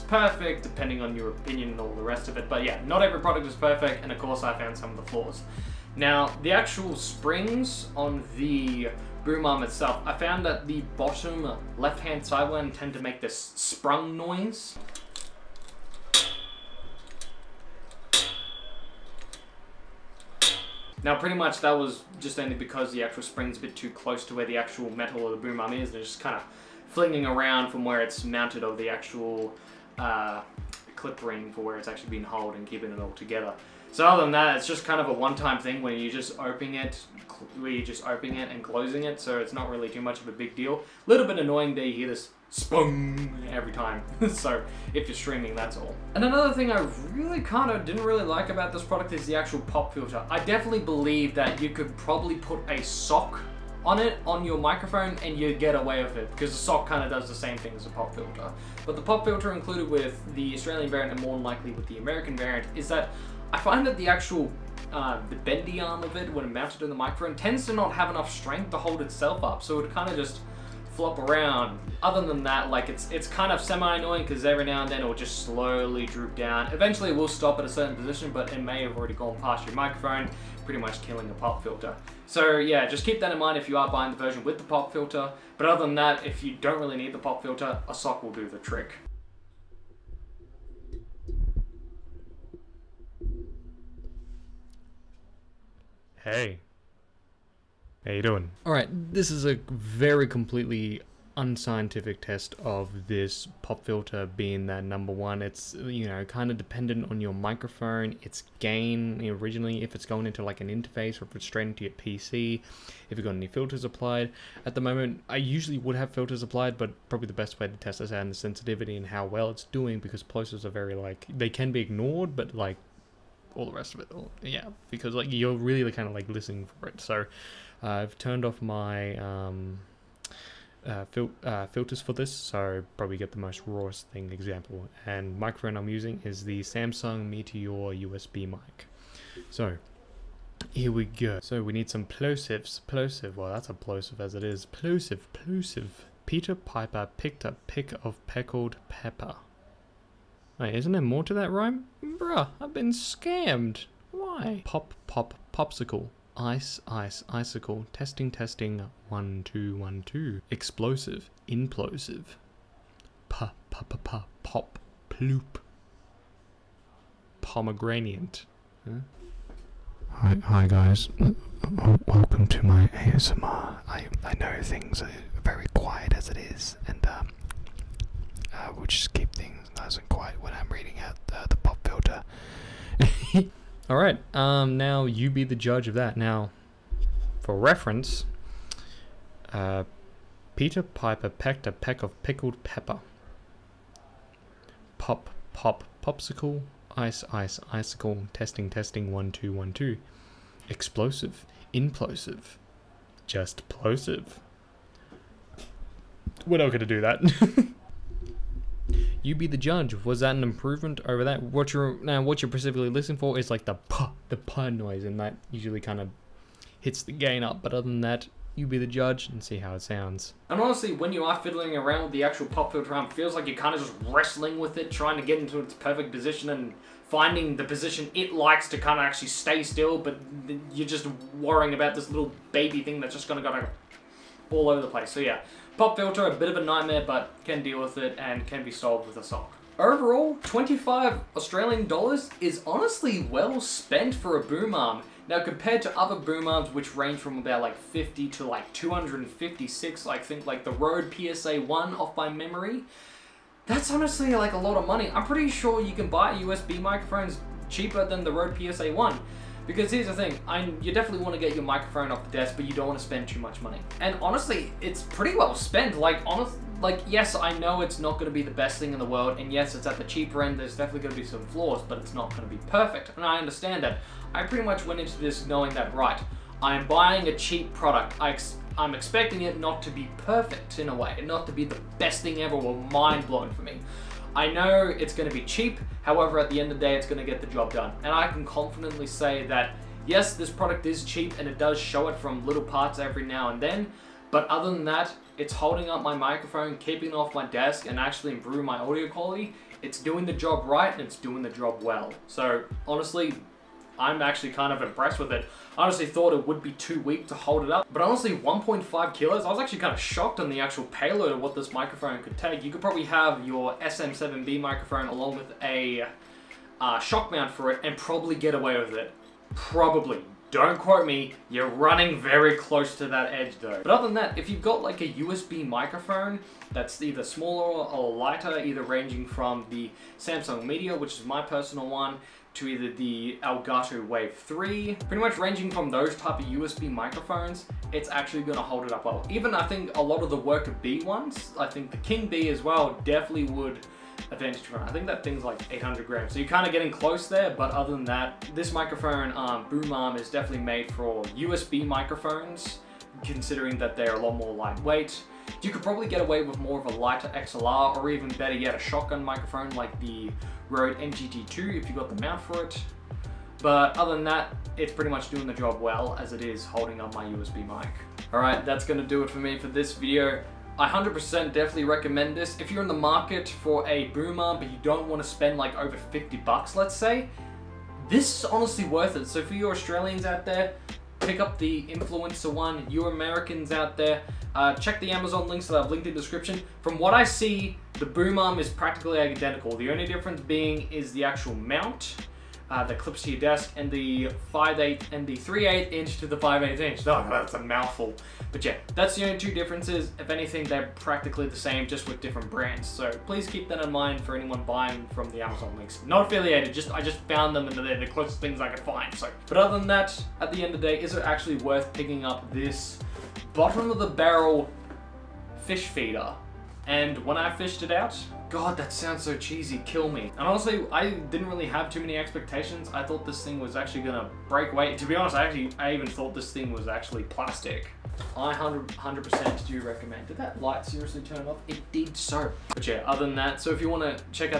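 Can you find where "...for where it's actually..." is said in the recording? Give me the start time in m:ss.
0:31.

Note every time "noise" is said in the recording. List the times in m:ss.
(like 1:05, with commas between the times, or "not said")
0:14, 3:34.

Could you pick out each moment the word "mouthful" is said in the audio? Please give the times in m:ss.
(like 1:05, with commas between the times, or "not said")
6:37.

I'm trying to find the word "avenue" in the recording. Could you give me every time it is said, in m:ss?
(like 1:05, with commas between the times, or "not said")
not said.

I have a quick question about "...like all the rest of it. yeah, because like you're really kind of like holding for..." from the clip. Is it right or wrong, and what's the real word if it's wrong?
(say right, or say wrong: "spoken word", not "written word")
wrong: "listening", not "holding".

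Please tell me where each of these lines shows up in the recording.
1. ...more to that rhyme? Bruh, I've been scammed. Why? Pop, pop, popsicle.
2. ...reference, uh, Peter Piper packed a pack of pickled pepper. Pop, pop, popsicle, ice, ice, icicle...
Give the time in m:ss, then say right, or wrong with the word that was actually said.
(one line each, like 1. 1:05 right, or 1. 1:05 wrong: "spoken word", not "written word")
1. 2:31 right
2. 3:07 right.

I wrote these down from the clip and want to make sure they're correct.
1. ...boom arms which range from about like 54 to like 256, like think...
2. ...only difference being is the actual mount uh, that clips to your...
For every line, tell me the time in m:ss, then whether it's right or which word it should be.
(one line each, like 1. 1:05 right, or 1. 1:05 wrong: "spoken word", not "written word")
1. 4:06 wrong: "50", not "54"
2. 6:29 right.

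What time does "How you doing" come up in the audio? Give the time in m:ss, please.
1:38.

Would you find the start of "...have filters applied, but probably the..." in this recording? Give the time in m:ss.
1:55.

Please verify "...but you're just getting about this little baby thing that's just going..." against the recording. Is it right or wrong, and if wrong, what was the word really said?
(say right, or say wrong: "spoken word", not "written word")
wrong: "worrying", not "getting".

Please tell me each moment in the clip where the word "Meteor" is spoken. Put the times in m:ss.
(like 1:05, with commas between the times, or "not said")
2:17, 5:30.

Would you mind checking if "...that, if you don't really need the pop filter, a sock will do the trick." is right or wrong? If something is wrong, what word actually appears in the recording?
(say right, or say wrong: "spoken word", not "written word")
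right.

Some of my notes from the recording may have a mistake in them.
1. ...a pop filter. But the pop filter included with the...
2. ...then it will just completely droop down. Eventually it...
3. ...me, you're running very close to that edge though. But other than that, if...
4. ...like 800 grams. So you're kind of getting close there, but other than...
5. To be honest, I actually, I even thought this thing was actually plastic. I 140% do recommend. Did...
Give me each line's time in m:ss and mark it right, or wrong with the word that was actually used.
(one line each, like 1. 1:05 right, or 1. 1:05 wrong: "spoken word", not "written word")
1. 0:57 right
2. 1:14 wrong: "slowly", not "completely"
3. 5:21 right
4. 5:45 right
5. 7:04 wrong: "100", not "140".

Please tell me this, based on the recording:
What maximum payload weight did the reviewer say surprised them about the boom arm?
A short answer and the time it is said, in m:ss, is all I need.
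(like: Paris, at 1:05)
1.5 kilos, at 5:08.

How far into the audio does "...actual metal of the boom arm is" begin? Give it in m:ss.
0:24.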